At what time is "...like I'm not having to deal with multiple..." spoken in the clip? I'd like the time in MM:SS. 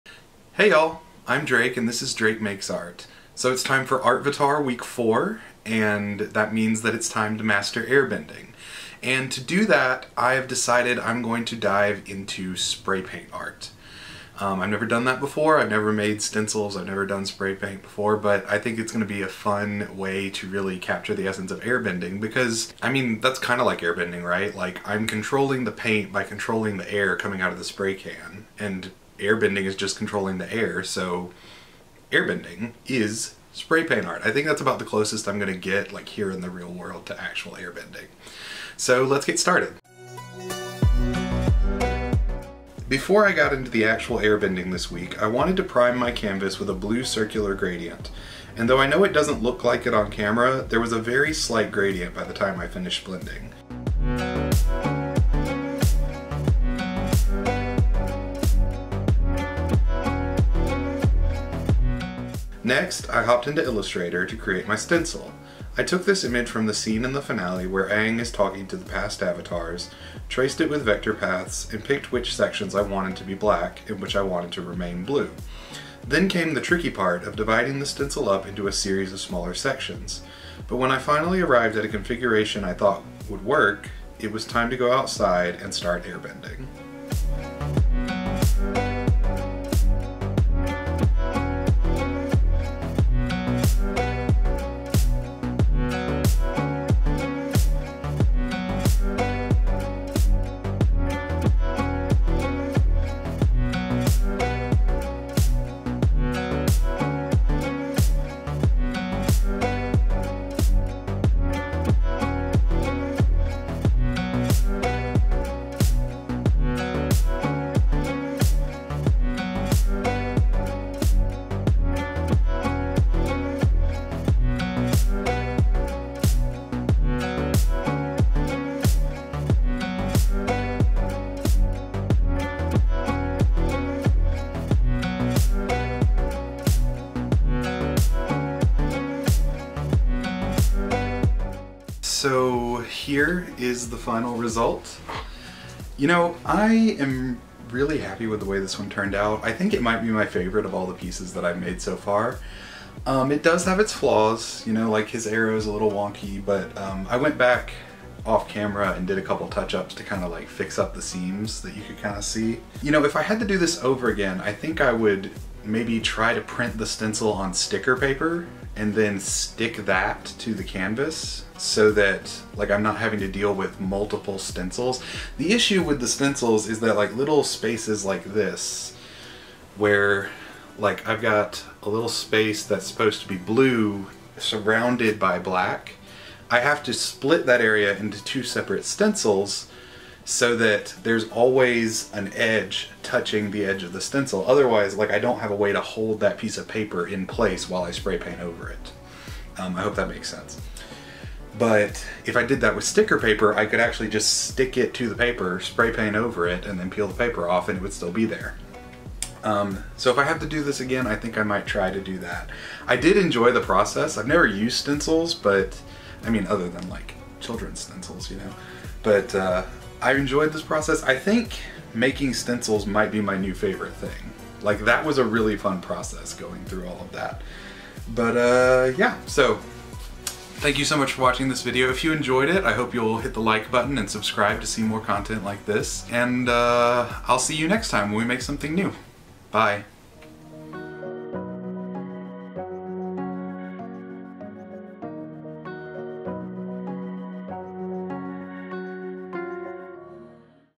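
02:52.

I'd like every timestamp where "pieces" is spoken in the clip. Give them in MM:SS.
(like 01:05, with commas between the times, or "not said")
02:30, 03:16.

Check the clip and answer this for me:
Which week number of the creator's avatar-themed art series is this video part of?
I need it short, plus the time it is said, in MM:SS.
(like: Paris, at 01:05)
4, at 00:04.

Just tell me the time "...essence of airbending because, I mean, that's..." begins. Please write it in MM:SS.
00:21.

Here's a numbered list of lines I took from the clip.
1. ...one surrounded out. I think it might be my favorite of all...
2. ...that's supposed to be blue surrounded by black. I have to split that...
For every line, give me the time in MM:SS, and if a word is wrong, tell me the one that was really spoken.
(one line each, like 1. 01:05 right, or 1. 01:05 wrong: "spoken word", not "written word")
1. 02:28 wrong: "turned", not "surrounded"
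2. 03:02 right.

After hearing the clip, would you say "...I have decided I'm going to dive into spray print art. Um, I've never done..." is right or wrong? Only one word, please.
wrong.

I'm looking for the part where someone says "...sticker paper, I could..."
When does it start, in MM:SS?
03:22.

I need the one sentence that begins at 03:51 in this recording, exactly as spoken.
If you enjoyed it, I hope you'll hit the like button and subscribe to see more content like this.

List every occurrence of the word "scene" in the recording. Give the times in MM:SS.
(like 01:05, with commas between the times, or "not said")
01:06.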